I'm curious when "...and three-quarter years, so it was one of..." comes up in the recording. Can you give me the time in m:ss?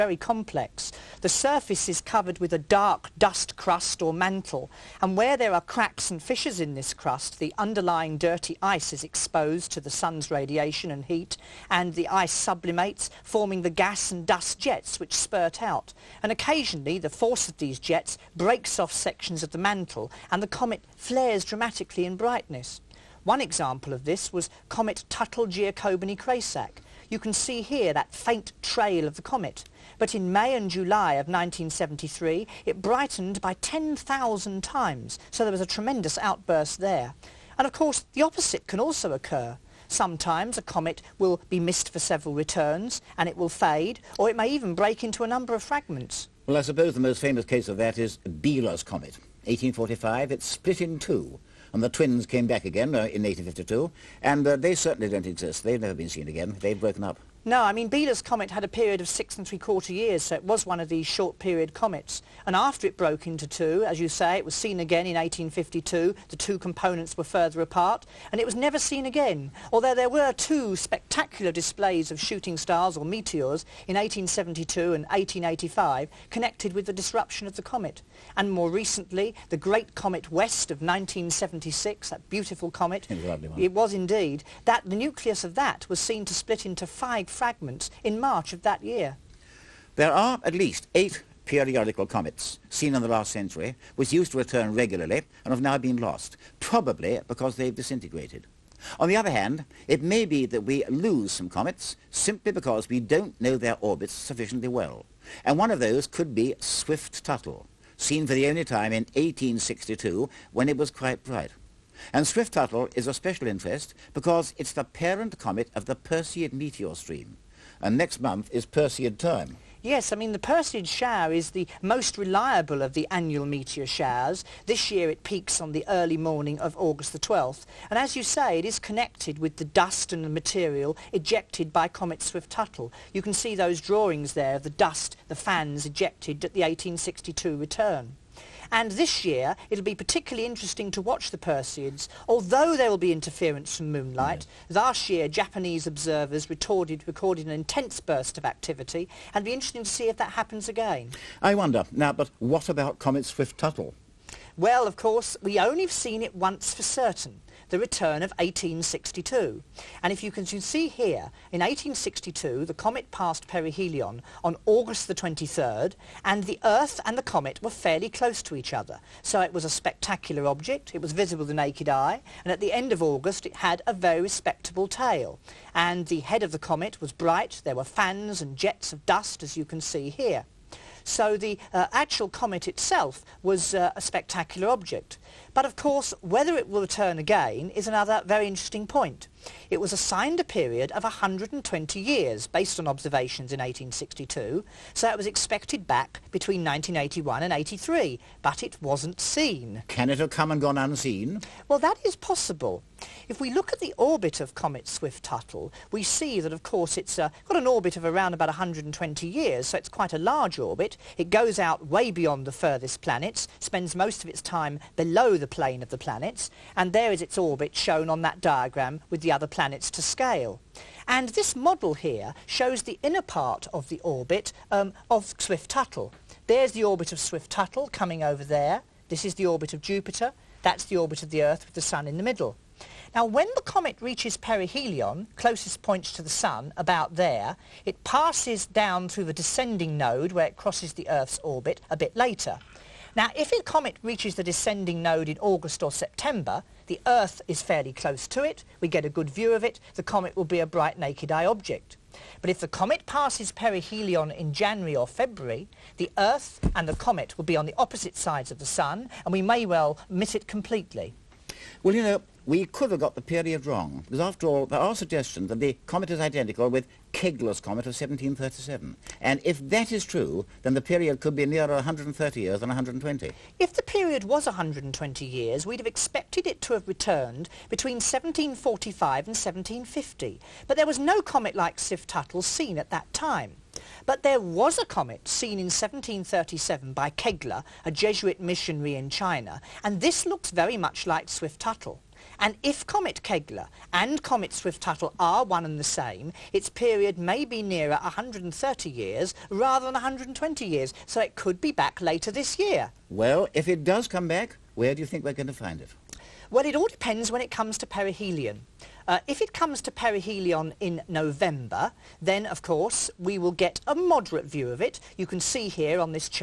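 0:59.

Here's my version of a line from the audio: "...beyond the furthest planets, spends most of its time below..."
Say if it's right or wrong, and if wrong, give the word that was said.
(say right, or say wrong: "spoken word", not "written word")
right.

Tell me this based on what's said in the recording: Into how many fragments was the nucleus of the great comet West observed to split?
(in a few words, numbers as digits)
5.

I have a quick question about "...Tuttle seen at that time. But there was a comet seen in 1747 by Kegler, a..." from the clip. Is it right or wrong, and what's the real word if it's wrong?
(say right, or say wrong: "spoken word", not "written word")
wrong: "1737", not "1747".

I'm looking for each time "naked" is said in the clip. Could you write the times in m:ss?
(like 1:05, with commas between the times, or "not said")
2:51, 4:10.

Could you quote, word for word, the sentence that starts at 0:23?
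One example of this was comet Tuttle-Giacobini-Kresák, you can see here that faint trail of the comet.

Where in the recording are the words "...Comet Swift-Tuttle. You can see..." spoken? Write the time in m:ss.
2:11.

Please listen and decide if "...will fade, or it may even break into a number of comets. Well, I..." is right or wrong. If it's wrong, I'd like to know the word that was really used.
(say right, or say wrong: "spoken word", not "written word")
wrong: "fragments", not "comets".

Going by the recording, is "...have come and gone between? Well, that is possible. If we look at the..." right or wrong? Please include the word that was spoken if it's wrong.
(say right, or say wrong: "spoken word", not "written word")
wrong: "unseen", not "between".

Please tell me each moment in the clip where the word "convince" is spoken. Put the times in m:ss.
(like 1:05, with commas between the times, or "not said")
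not said.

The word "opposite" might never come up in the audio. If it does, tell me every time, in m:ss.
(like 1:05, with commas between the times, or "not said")
0:38, 4:17.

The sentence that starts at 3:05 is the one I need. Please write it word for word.
But of course, whether it will return again is another very interesting point.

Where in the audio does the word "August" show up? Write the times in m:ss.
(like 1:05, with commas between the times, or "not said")
2:06, 2:44, 2:53, 4:05.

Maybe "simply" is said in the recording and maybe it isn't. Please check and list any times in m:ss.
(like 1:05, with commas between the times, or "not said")
1:42.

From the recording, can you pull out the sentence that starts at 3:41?
And this model here shows the inner part of the orbit um, of Swift-Tuttle.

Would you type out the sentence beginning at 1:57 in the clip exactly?
And next month is Perseid time.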